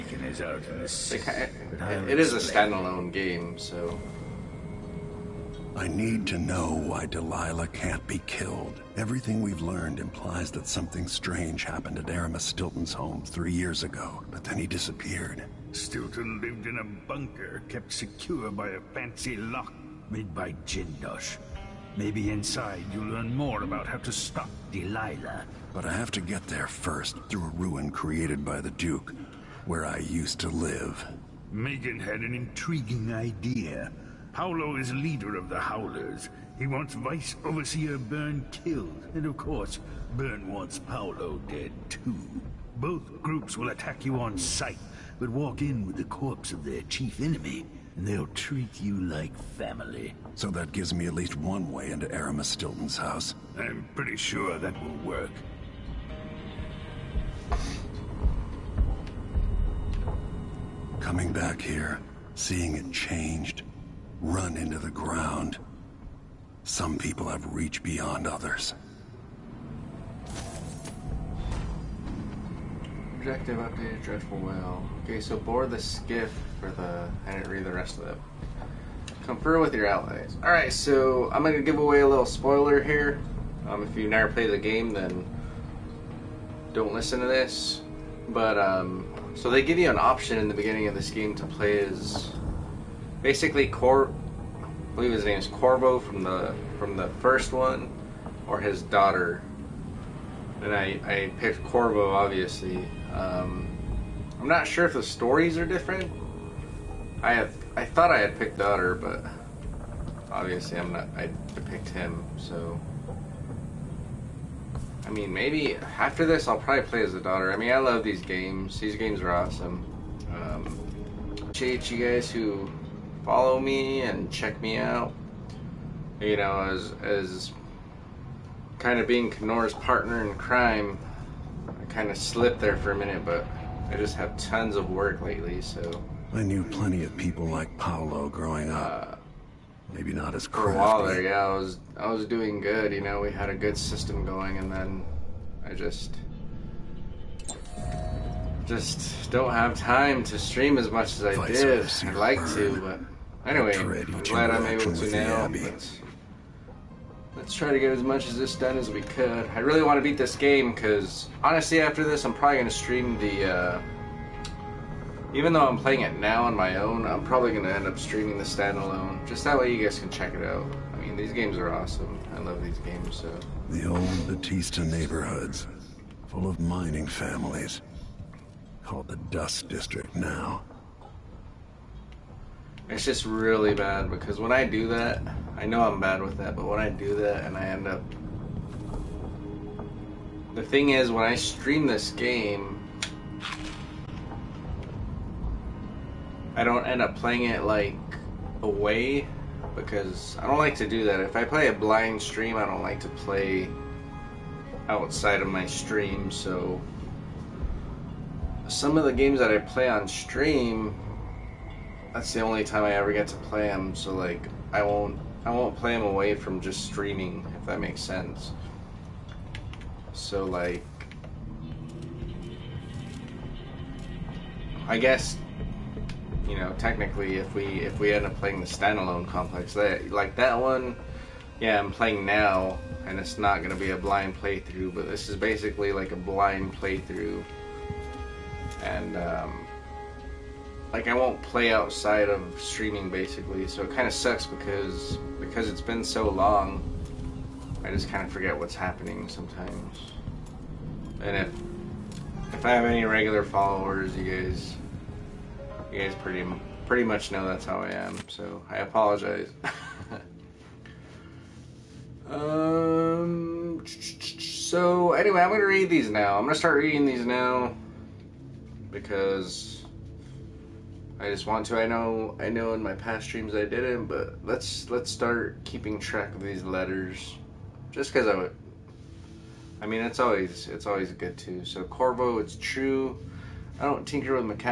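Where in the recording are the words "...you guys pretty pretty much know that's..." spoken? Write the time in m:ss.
4:15.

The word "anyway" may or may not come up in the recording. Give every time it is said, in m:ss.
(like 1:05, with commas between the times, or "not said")
2:33, 4:25.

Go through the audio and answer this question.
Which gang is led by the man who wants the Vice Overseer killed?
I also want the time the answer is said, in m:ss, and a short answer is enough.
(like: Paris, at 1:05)
the Howlers, at 0:35.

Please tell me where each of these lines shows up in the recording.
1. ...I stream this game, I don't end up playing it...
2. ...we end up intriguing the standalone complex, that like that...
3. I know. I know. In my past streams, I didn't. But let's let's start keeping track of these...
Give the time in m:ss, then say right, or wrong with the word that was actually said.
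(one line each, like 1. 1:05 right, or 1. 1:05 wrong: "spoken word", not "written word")
1. 3:11 right
2. 3:47 wrong: "playing", not "intriguing"
3. 4:31 right.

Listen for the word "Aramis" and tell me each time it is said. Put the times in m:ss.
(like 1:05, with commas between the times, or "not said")
0:12, 0:52.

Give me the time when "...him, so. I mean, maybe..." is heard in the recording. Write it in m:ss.
1:51.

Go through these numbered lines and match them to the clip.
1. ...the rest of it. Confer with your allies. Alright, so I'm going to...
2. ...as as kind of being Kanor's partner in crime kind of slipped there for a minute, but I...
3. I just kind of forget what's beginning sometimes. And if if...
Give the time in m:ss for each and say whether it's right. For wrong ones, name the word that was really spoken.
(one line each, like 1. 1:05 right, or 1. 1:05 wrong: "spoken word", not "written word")
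1. 1:17 right
2. 2:06 right
3. 4:07 wrong: "happening", not "beginning".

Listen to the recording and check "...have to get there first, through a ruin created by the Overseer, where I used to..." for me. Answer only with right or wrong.
wrong.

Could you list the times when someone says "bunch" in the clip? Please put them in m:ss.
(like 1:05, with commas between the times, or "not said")
not said.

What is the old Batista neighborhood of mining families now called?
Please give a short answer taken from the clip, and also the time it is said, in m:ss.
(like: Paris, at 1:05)
Dust District, at 2:59.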